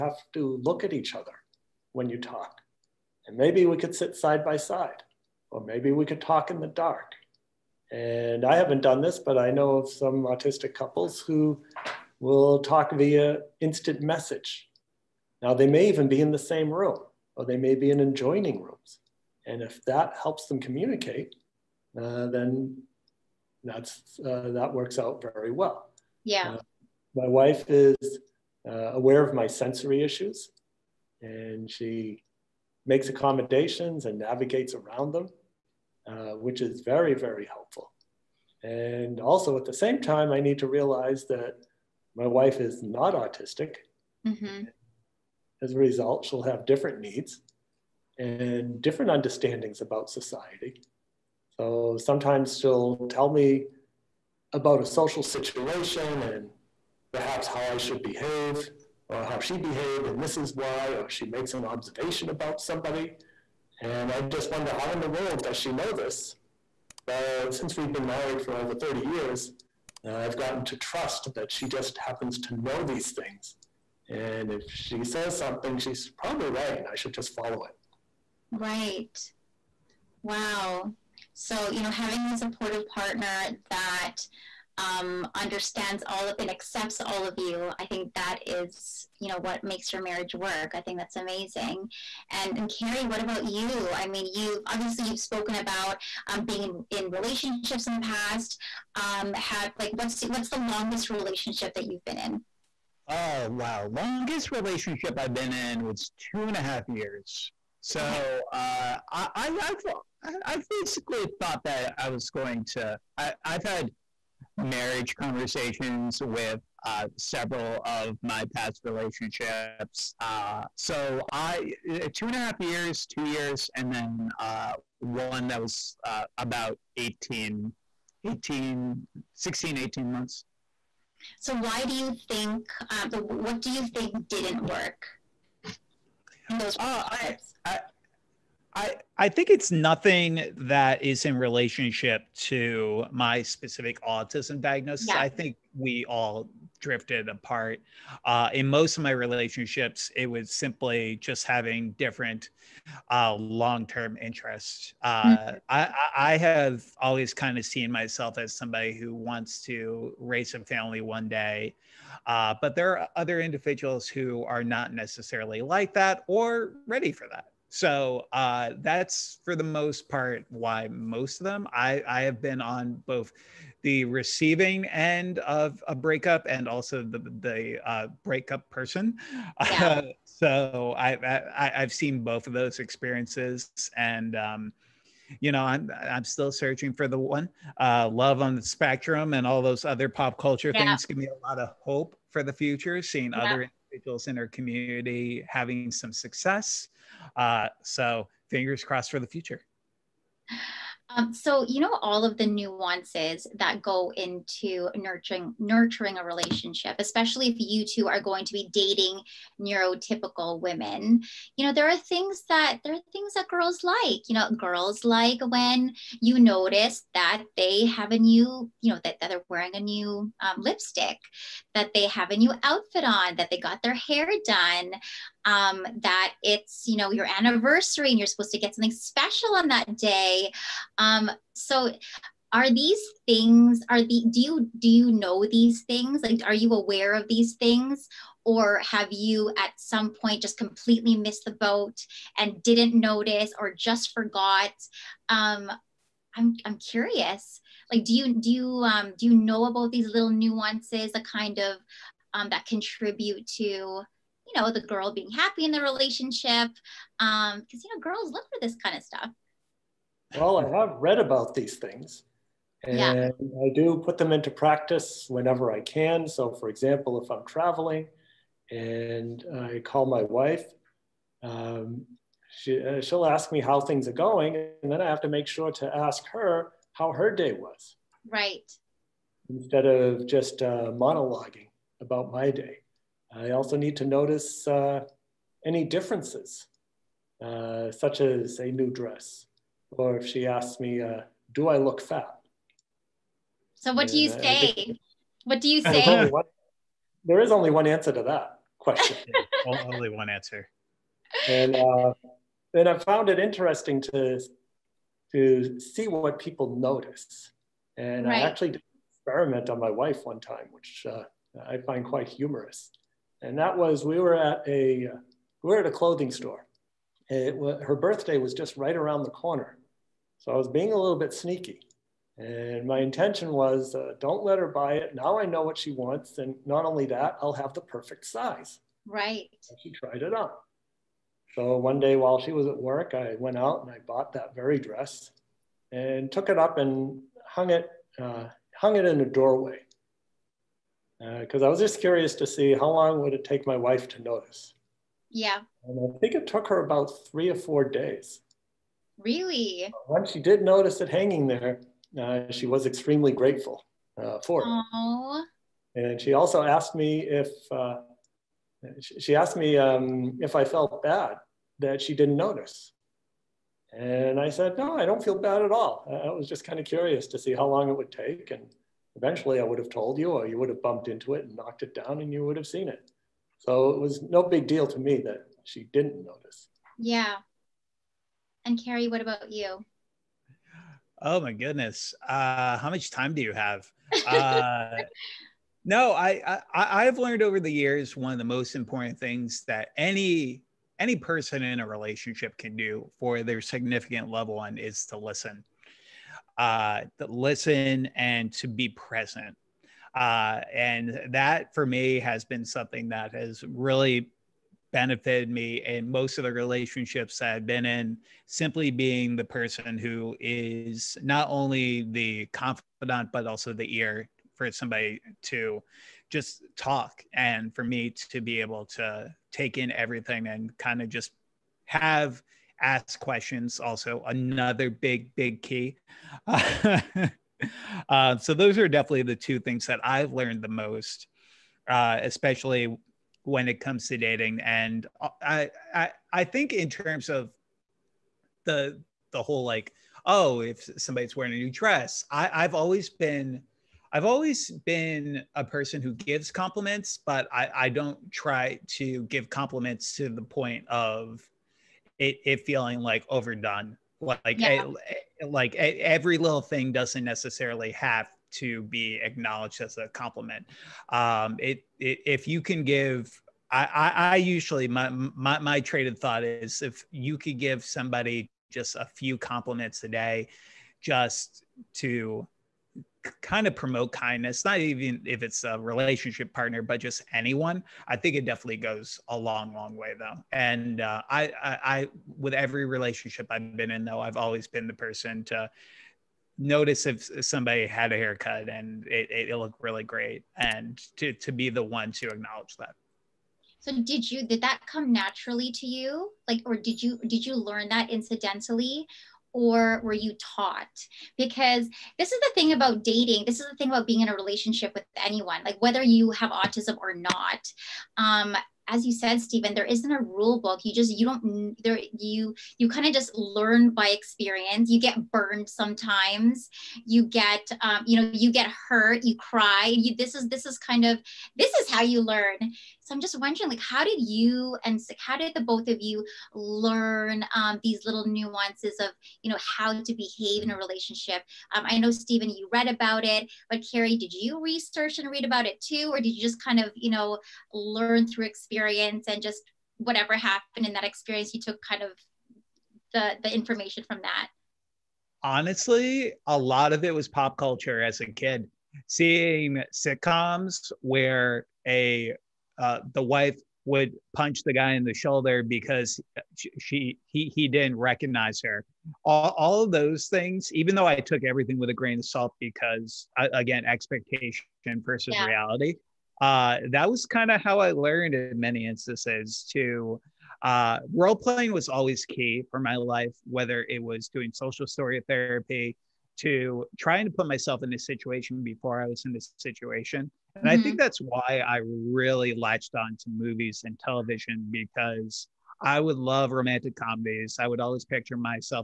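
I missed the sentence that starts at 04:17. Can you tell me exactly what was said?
Um, because you know, girls look for this kind of stuff.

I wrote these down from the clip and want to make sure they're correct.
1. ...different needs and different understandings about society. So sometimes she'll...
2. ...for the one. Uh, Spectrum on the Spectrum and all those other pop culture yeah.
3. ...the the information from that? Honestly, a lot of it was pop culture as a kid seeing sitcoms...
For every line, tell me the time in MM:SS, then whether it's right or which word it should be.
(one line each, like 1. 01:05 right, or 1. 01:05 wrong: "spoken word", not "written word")
1. 00:46 right
2. 03:06 wrong: "Love", not "Spectrum"
3. 09:03 right.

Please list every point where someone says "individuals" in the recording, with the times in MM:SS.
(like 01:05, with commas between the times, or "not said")
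02:43, 03:13.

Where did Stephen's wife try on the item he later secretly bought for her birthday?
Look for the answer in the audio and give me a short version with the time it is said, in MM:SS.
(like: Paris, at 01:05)
a clothing store, at 05:15.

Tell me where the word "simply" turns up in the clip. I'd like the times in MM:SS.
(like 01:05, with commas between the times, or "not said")
02:30, 06:48.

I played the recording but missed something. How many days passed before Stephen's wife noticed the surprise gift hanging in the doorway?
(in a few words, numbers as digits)
3 or 4 days.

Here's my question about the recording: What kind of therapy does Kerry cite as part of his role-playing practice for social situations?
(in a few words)
social story therapy.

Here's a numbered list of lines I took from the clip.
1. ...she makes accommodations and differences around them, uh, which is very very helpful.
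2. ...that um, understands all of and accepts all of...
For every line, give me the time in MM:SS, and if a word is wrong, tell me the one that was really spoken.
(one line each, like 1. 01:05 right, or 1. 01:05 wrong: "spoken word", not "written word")
1. 00:31 wrong: "navigates", not "differences"
2. 01:23 right.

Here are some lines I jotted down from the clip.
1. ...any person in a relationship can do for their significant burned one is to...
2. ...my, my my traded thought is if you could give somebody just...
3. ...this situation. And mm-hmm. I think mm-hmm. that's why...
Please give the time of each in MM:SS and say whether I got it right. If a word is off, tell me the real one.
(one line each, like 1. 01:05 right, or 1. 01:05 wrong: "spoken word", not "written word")
1. 06:30 wrong: "loved", not "burned"
2. 07:44 right
3. 09:39 right.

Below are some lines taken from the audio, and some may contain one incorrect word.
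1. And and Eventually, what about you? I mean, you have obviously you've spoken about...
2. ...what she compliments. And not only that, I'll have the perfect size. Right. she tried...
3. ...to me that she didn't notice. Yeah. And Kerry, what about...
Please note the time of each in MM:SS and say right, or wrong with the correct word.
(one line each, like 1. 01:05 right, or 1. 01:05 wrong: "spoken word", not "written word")
1. 01:32 wrong: "Kerry", not "Eventually"
2. 05:25 wrong: "wants", not "compliments"
3. 06:14 right.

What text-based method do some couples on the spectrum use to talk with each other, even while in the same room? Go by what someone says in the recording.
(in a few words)
instant message.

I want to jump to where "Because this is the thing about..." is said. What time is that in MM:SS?
08:21.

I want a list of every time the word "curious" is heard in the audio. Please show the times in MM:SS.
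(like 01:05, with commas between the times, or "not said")
04:06, 05:41, 06:06.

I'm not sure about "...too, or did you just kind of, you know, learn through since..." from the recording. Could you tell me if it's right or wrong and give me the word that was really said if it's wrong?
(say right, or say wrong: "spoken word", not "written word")
wrong: "experience", not "since".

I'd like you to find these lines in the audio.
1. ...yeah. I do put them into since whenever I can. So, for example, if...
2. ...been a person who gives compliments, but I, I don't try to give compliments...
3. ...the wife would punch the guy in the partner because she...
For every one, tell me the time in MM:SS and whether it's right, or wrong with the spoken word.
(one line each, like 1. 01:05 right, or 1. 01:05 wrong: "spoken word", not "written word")
1. 04:22 wrong: "practice", not "since"
2. 07:24 right
3. 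09:13 wrong: "shoulder", not "partner".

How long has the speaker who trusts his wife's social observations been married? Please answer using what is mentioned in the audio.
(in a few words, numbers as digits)
over 30 years.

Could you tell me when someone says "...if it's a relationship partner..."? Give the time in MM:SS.
07:55.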